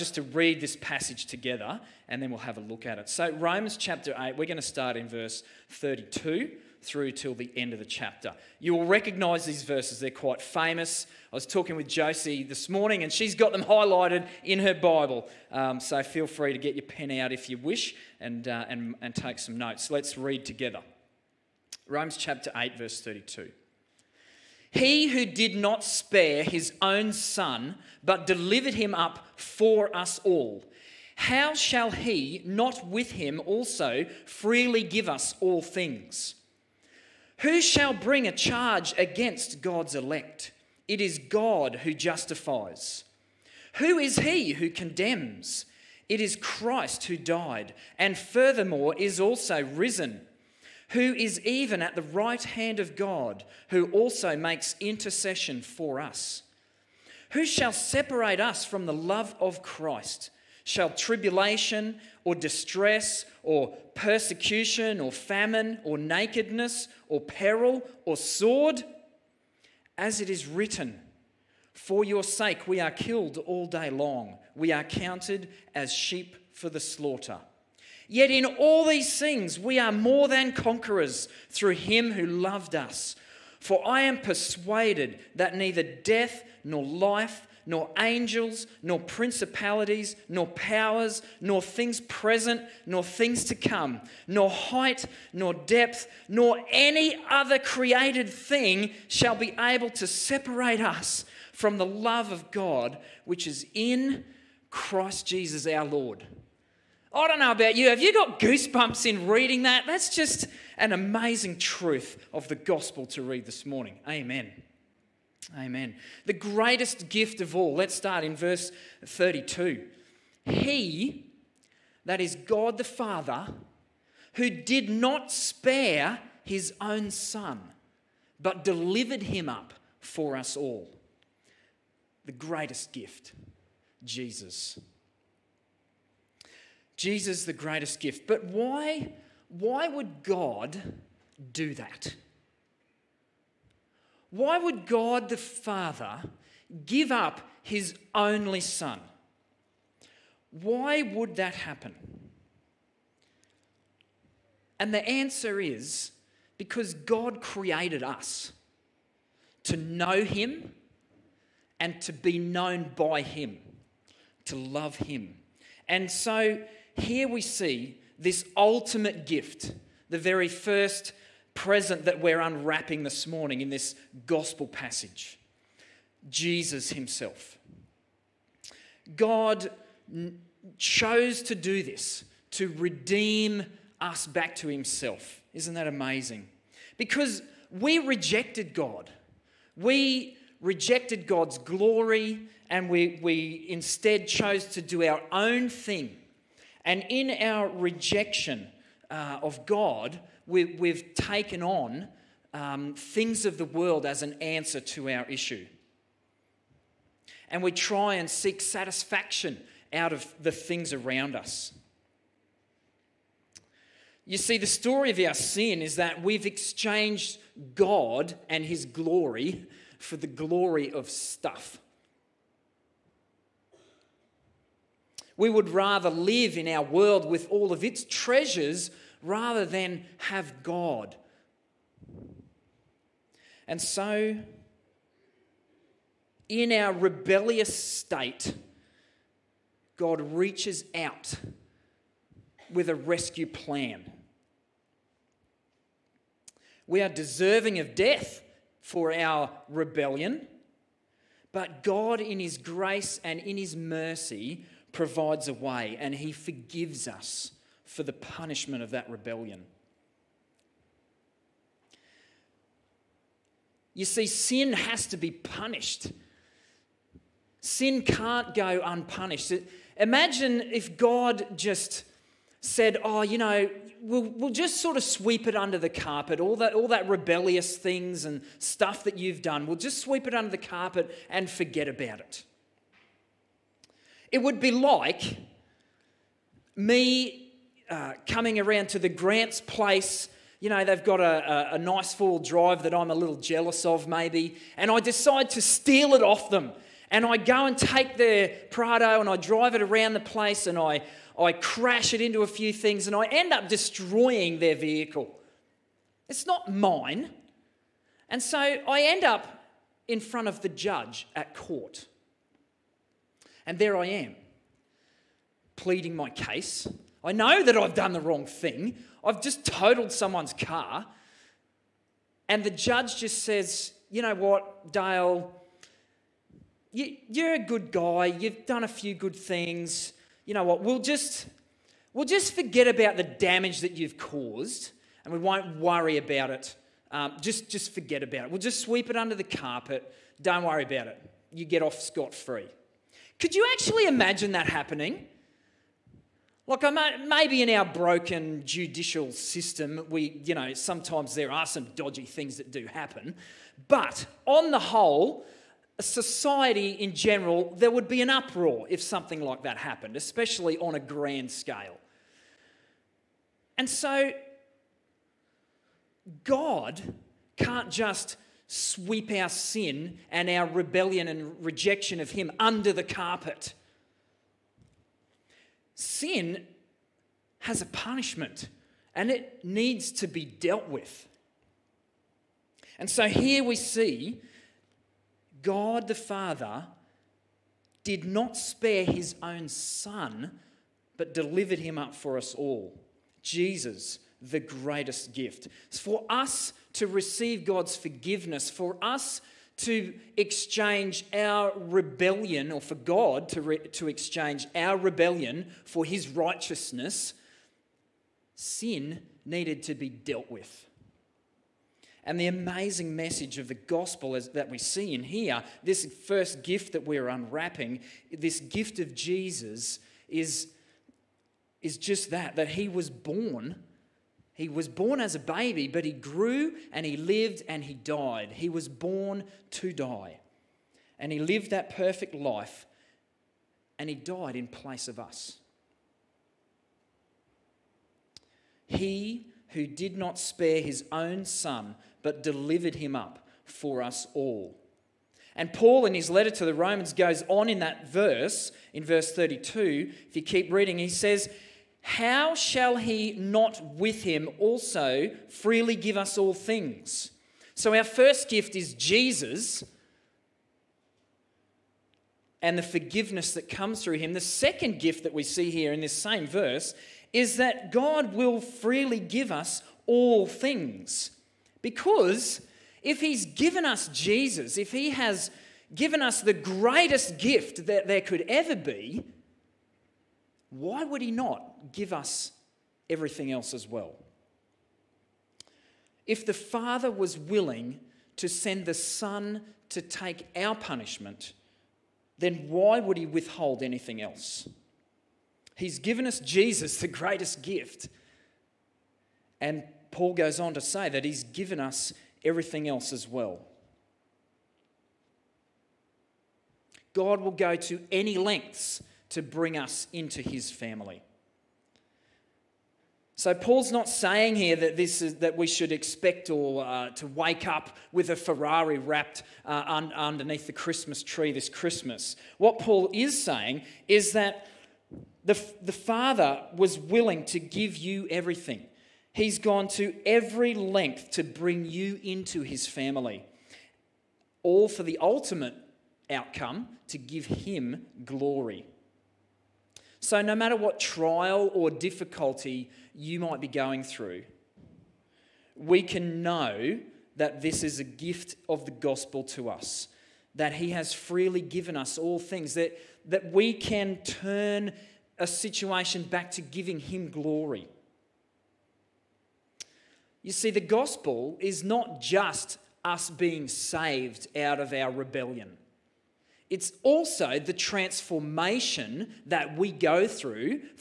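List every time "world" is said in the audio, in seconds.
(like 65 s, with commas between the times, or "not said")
203 s, 226 s.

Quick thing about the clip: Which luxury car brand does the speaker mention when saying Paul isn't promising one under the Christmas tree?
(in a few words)
Ferrari.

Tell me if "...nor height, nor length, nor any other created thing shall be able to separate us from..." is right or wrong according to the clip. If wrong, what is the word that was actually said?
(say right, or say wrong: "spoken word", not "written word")
wrong: "depth", not "length".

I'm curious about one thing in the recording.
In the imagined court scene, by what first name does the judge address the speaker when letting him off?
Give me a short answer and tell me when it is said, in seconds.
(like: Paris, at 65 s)
Dale, at 324 s.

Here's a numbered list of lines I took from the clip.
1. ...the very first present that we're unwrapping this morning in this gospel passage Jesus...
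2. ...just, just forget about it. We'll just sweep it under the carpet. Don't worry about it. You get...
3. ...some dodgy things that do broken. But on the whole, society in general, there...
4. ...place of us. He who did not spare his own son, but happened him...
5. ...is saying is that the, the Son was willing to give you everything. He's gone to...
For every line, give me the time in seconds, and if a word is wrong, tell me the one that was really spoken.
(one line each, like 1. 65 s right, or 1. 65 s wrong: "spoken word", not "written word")
1. 170 s right
2. 337 s right
3. 351 s wrong: "happen", not "broken"
4. 434 s wrong: "delivered", not "happened"
5. 523 s wrong: "Father", not "Son".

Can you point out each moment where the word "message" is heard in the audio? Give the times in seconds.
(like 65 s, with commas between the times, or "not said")
413 s.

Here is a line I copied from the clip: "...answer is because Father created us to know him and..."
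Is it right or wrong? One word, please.
wrong.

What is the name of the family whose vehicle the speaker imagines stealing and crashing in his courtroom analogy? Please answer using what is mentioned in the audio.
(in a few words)
Grants.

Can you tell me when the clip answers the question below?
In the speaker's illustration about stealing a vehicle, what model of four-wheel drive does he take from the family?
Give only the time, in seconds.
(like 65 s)
298 s.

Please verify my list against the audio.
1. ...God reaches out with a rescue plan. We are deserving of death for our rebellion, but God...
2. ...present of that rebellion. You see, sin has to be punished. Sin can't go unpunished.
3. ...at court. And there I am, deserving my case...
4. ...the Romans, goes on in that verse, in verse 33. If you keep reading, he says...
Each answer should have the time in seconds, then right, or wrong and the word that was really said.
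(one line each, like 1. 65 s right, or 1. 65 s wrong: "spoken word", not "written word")
1. 239 s right
2. 258 s wrong: "punishment", not "present"
3. 311 s wrong: "pleading", not "deserving"
4. 446 s wrong: "32", not "33".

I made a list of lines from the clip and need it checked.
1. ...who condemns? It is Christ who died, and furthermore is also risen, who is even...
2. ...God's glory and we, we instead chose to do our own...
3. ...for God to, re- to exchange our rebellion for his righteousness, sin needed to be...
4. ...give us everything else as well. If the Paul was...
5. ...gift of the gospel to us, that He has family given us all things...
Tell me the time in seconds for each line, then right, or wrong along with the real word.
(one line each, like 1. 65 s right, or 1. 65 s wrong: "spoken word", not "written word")
1. 44 s right
2. 191 s right
3. 402 s right
4. 481 s wrong: "Father", not "Paul"
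5. 548 s wrong: "freely", not "family".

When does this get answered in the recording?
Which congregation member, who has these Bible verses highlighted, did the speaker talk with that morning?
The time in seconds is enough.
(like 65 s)
11 s.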